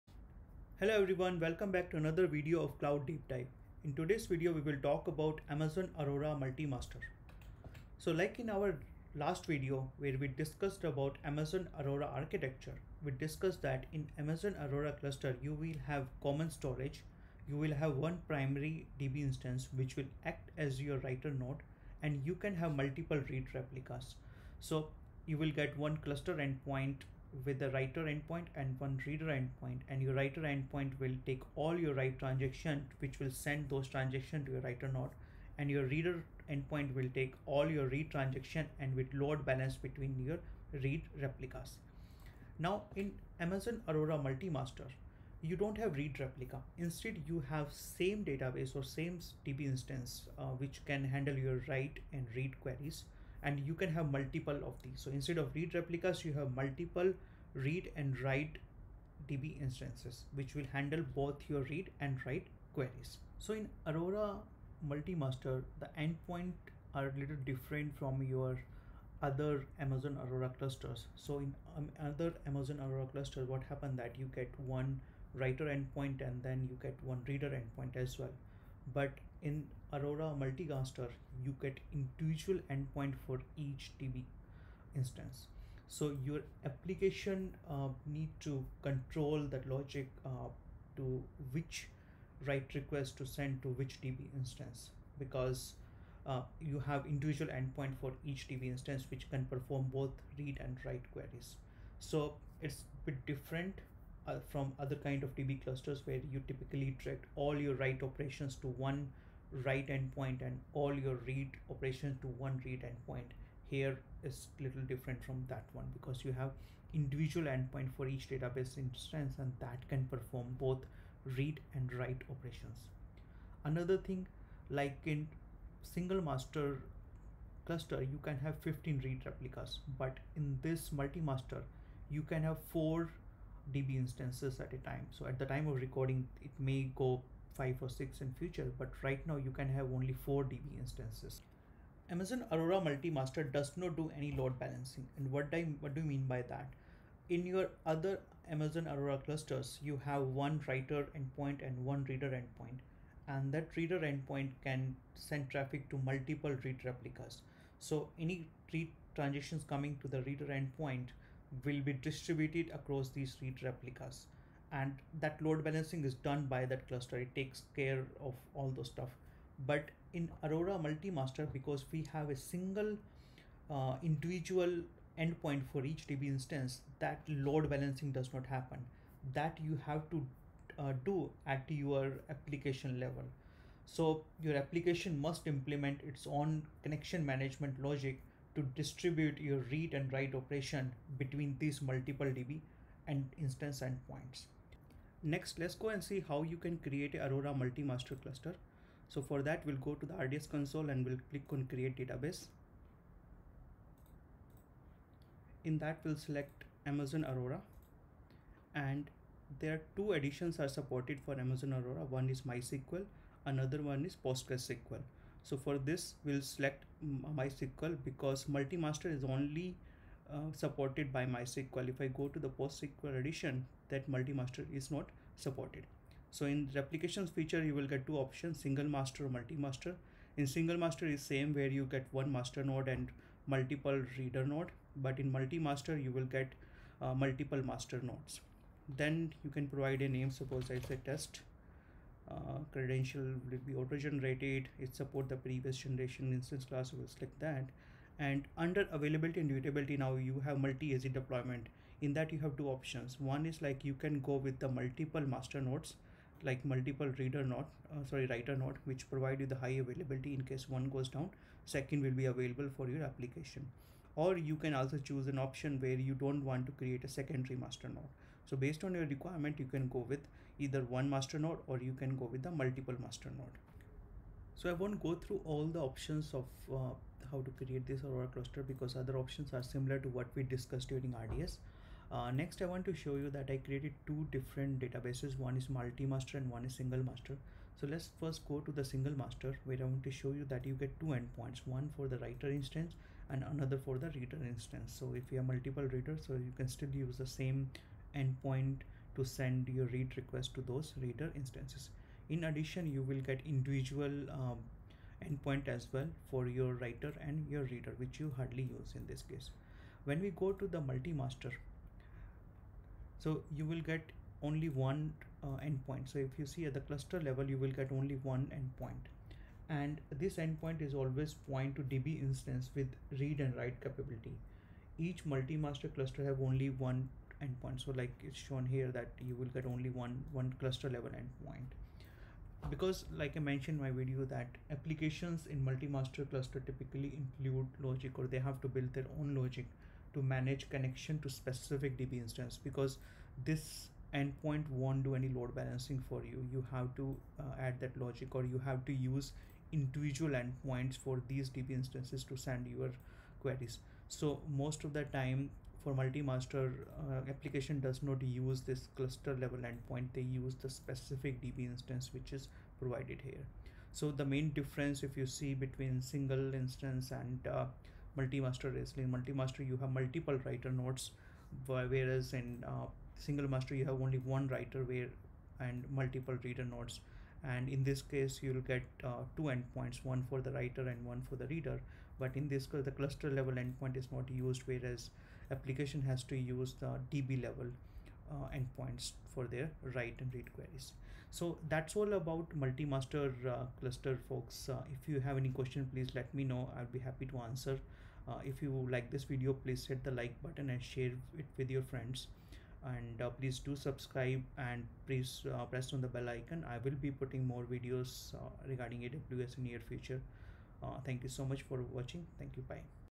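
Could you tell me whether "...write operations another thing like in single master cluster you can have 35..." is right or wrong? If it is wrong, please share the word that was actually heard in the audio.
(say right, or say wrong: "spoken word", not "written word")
wrong: "15", not "35".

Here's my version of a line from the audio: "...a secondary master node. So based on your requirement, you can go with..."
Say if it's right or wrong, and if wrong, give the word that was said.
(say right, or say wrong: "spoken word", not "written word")
right.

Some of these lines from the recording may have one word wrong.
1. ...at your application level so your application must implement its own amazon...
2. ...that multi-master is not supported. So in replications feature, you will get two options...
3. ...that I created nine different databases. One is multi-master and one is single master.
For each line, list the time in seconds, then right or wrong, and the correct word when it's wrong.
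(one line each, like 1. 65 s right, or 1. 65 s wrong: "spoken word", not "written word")
1. 181 s wrong: "connection", not "amazon"
2. 223 s right
3. 283 s wrong: "two", not "nine".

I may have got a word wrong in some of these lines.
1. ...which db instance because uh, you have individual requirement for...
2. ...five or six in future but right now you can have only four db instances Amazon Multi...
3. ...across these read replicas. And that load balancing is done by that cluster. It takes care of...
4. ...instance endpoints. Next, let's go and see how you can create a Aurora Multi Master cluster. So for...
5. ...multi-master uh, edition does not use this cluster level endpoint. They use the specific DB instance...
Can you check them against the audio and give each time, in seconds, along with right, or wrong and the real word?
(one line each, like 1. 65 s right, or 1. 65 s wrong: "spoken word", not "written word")
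1. 93 s wrong: "endpoint", not "requirement"
2. 137 s wrong: "Aurora", not "Multi"
3. 162 s right
4. 193 s right
5. 355 s wrong: "application", not "edition".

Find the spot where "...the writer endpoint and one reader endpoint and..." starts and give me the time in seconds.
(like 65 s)
27 s.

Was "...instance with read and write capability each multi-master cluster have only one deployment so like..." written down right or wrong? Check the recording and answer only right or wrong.
wrong.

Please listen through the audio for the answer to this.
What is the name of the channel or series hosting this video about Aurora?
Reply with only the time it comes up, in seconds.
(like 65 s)
2 s.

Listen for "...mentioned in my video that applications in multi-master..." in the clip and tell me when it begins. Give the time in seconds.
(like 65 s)
333 s.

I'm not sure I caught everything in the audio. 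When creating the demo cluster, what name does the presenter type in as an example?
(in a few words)
test.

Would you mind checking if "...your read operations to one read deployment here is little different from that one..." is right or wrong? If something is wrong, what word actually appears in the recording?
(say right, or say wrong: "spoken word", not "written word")
wrong: "endpoint", not "deployment".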